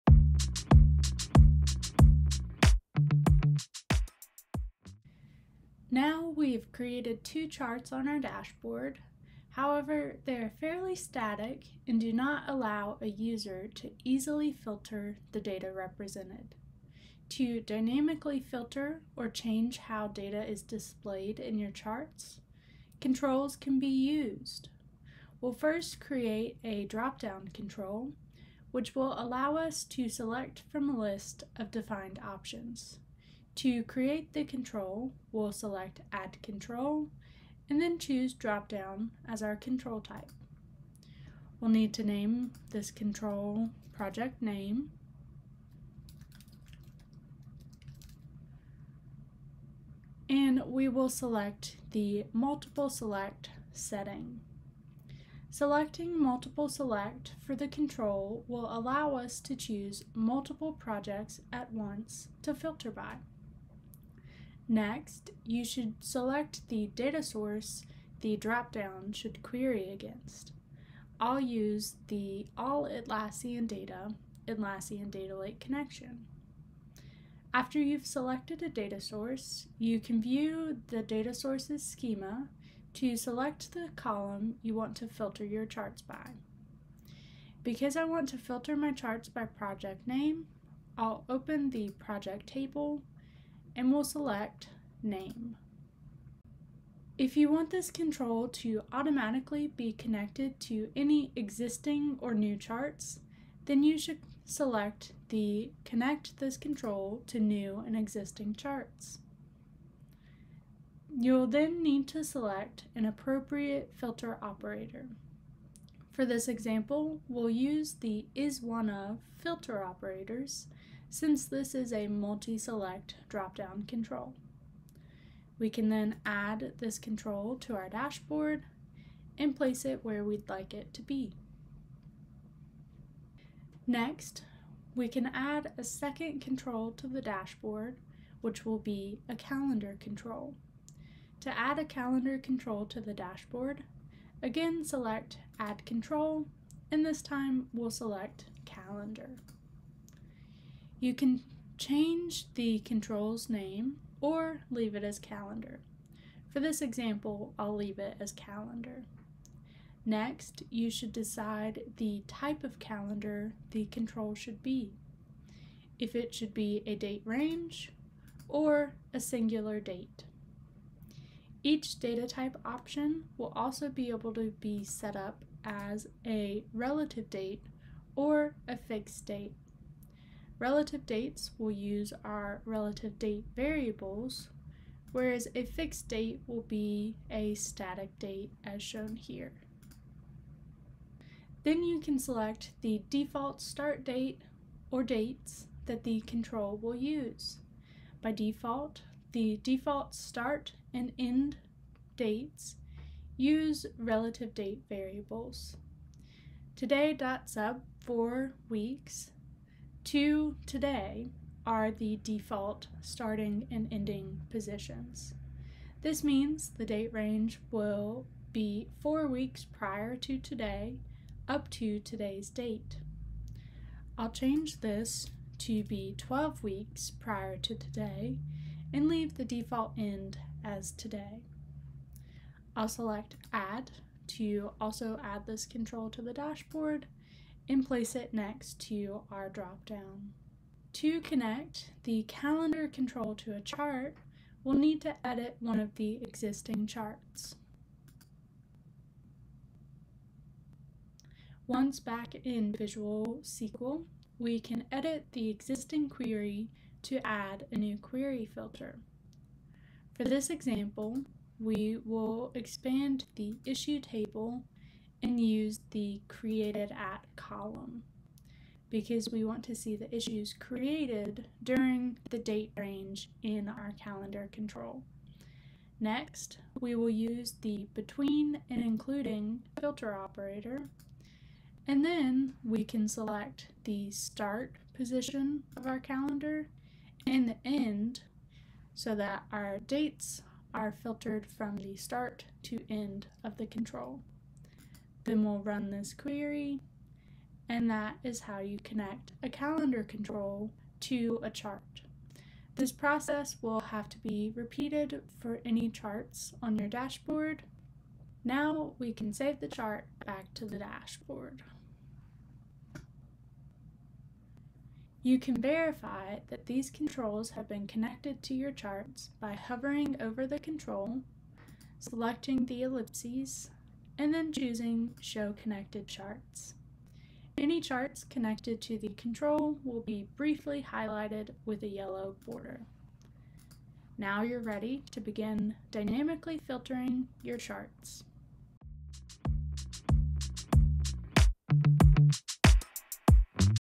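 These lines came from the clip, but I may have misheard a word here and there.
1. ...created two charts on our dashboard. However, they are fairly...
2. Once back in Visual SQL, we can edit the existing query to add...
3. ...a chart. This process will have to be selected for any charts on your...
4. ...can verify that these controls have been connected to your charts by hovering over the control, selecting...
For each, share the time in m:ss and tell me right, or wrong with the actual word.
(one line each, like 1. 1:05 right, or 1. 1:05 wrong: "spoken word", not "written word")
1. 0:06 right
2. 4:11 right
3. 5:01 wrong: "repeated", not "selected"
4. 5:15 right.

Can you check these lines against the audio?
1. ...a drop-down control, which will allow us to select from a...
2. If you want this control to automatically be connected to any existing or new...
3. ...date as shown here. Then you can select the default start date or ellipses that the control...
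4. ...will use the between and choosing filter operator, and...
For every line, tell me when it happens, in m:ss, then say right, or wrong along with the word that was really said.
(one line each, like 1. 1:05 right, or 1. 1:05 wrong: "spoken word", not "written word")
1. 0:26 right
2. 1:37 right
3. 3:08 wrong: "dates", not "ellipses"
4. 4:36 wrong: "including", not "choosing".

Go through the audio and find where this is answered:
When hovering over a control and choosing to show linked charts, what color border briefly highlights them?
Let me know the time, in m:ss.
5:31.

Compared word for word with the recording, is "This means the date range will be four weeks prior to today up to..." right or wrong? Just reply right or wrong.
right.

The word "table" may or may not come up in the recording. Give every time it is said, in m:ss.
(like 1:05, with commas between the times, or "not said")
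1:32, 4:23.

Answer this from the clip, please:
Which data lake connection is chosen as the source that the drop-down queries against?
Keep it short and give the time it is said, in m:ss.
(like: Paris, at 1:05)
Atlassian Data Lake, at 1:14.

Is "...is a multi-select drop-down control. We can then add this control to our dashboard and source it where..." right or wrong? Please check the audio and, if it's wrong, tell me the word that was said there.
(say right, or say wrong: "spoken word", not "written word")
wrong: "place", not "source".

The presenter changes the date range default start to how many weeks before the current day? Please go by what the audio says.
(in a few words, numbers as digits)
12.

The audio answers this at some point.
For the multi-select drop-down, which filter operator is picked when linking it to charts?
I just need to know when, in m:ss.
1:58.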